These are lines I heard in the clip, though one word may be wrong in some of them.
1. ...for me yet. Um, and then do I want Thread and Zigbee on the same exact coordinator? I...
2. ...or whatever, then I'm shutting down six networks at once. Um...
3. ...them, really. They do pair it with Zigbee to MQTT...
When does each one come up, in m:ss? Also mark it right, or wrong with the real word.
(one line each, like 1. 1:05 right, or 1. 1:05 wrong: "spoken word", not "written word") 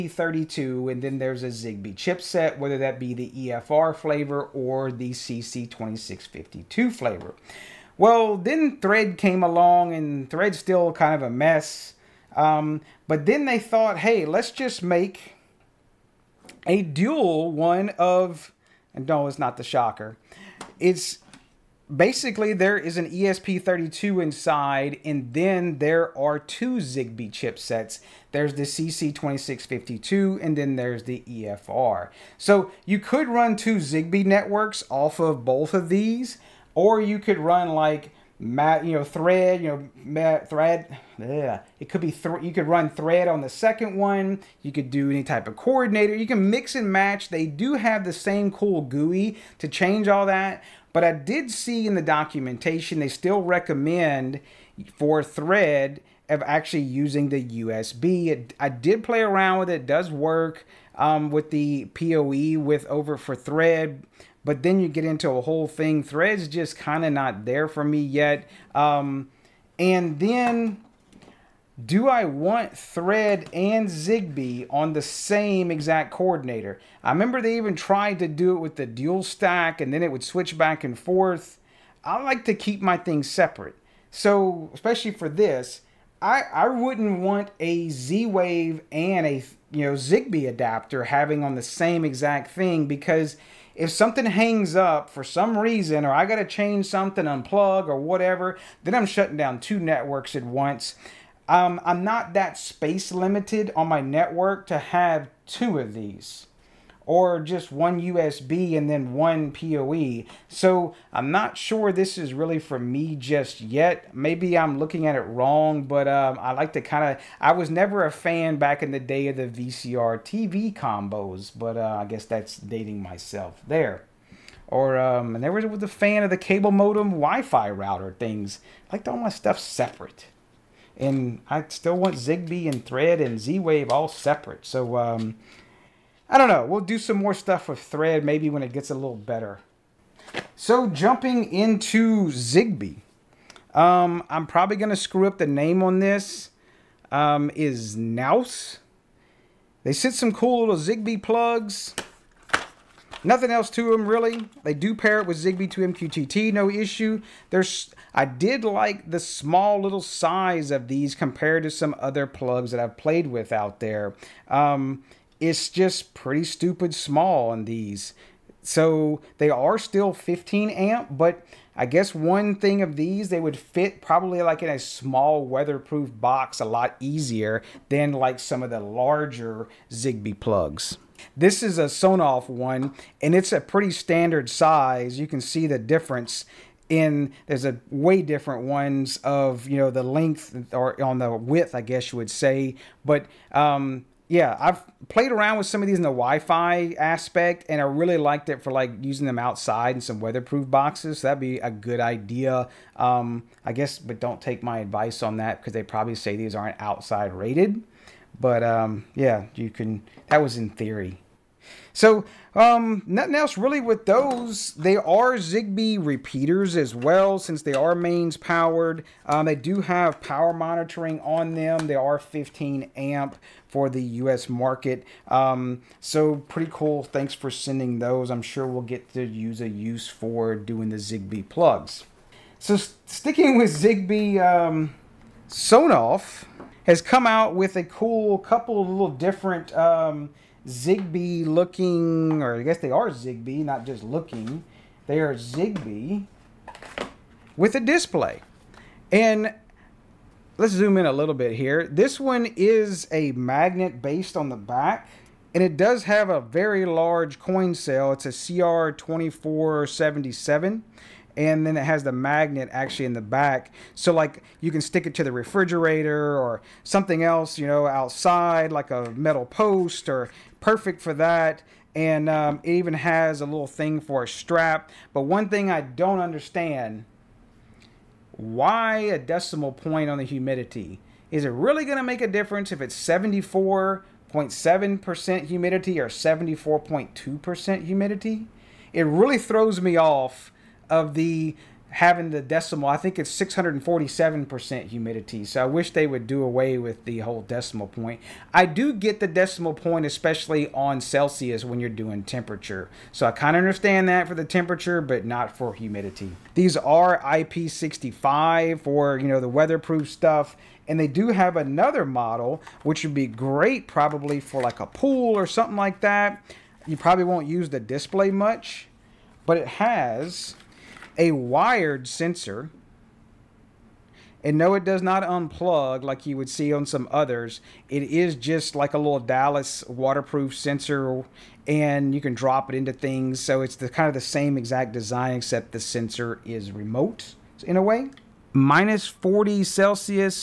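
1. 1:07 right
2. 1:37 wrong: "two", not "six"
3. 2:33 right.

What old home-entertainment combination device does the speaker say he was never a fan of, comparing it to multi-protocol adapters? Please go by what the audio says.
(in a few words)
VCR TV combos.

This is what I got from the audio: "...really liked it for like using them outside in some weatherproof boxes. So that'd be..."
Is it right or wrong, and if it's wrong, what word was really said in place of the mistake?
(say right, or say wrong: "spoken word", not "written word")
right.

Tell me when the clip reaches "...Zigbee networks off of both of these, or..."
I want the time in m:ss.
0:33.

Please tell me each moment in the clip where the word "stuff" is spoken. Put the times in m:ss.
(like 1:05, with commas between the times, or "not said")
2:09, 2:17, 5:10.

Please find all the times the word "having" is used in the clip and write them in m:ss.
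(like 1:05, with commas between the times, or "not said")
1:31, 4:51.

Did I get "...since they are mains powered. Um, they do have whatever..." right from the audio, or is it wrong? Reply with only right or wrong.
wrong.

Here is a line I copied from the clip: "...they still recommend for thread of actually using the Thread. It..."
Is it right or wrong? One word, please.
wrong.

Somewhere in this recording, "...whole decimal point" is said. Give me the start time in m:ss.
4:57.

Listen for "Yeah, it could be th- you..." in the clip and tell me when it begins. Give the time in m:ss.
0:41.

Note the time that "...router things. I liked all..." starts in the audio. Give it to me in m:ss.
2:07.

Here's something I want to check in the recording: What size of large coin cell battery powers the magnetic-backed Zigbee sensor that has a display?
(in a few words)
CR2477.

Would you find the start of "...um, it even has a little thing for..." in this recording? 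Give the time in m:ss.
4:32.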